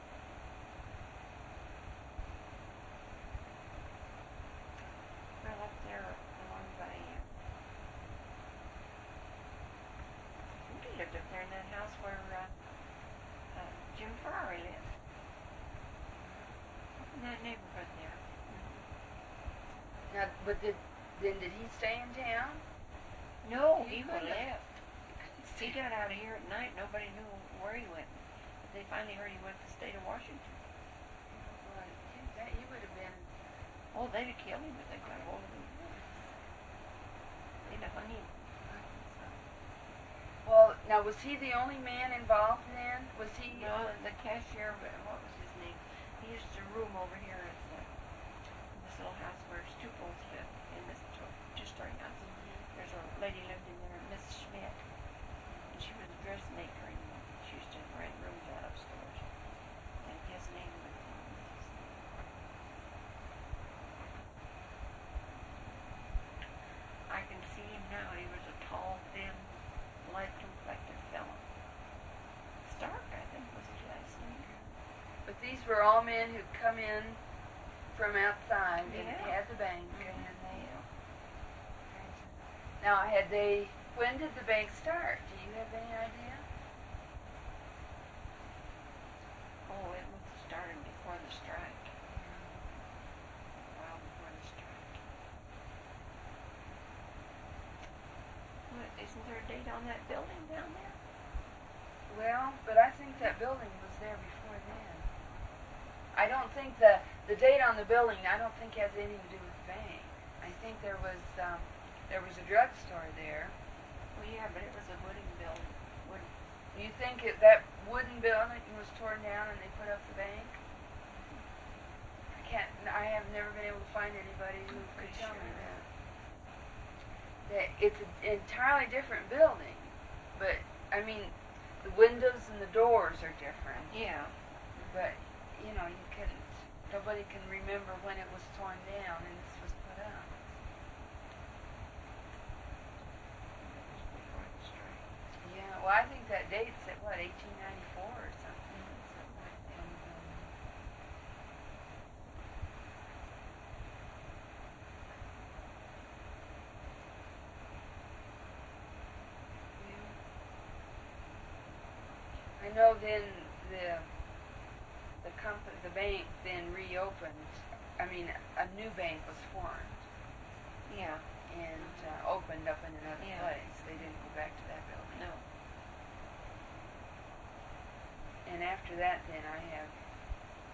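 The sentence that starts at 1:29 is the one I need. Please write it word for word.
Oh, it starting before the strike.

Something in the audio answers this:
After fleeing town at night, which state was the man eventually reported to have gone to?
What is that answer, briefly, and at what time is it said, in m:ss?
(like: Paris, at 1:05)
Washington, at 0:30.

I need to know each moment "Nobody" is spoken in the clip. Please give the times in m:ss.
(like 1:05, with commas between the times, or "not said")
0:26, 2:16.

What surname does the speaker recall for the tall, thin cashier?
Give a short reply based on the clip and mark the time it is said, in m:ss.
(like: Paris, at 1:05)
Stark, at 1:12.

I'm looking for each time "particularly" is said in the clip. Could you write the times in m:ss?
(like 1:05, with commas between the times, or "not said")
not said.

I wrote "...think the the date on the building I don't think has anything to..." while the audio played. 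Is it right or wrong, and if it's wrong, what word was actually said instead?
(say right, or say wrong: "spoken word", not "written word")
right.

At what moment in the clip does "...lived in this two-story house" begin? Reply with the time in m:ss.
0:50.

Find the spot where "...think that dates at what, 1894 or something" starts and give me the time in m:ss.
2:26.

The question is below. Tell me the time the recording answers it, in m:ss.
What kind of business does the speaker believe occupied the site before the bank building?
1:52.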